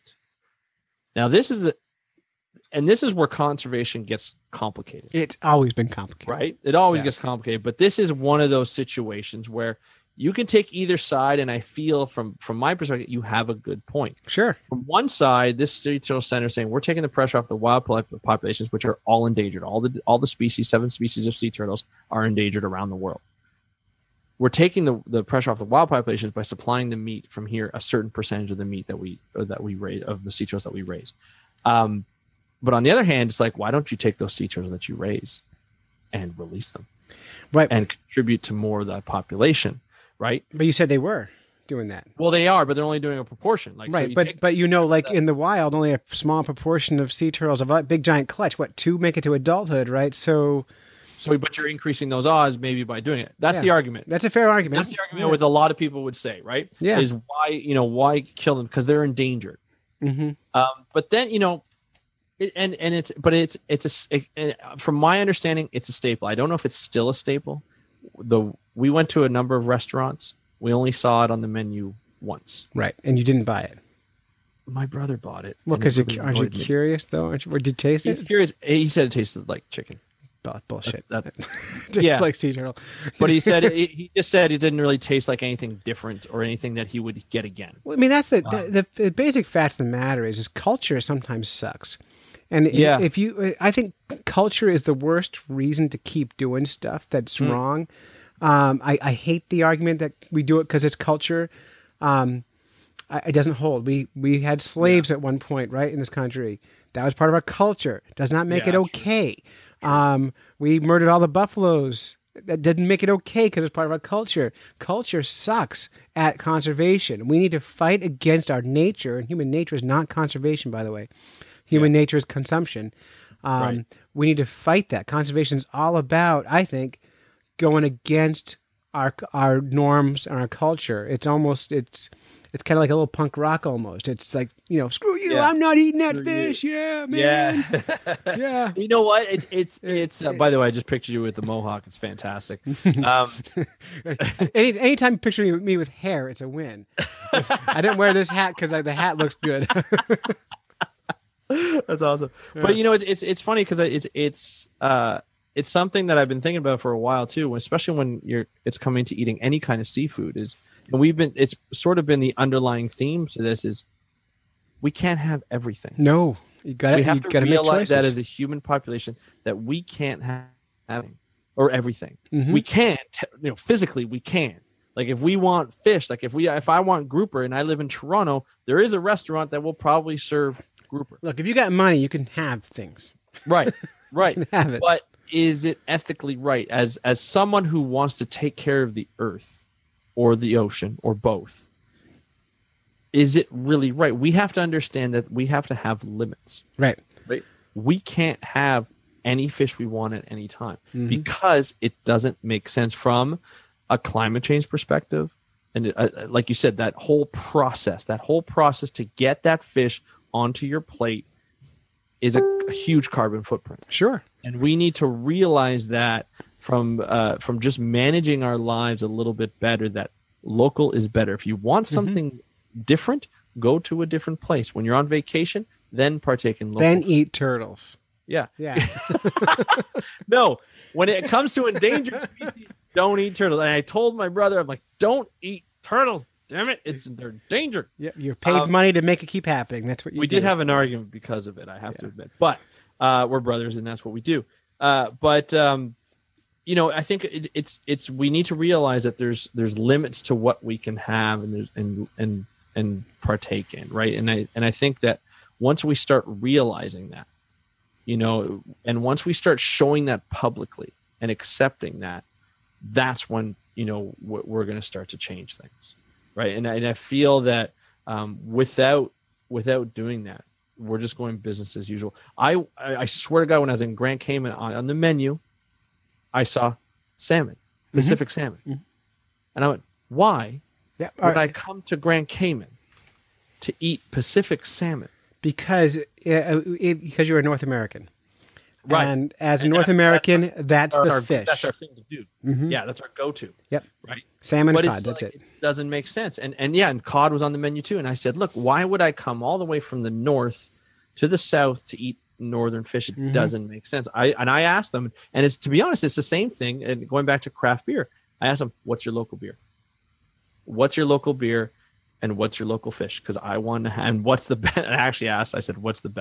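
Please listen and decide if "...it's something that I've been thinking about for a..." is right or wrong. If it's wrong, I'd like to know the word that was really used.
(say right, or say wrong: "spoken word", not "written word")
right.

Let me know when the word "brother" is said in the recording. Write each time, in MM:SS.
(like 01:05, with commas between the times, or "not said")
01:14, 03:54, 04:03.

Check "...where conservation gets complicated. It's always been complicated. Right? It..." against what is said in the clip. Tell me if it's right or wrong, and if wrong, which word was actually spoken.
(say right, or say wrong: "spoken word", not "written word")
right.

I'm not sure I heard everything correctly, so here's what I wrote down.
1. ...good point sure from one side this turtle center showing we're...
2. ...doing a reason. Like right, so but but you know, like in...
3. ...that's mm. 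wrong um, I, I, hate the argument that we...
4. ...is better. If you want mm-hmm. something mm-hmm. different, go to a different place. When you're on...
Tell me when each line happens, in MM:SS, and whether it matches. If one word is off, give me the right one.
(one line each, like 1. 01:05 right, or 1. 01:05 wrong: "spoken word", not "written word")
1. 00:13 wrong: "saying", not "showing"
2. 00:43 wrong: "proportion", not "reason"
3. 01:37 right
4. 03:40 right.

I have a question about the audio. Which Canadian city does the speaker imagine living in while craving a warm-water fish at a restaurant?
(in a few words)
Toronto.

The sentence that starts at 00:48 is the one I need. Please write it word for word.
What two make it to adulthood, right?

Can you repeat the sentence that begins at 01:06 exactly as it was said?
I don't know if it's still a staple.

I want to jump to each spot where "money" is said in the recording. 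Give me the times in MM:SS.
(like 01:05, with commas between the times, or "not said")
03:01, 03:58.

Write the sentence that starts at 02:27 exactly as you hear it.
I didn't wear this hat because the hat looks good.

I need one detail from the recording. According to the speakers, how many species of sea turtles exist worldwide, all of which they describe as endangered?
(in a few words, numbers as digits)
7.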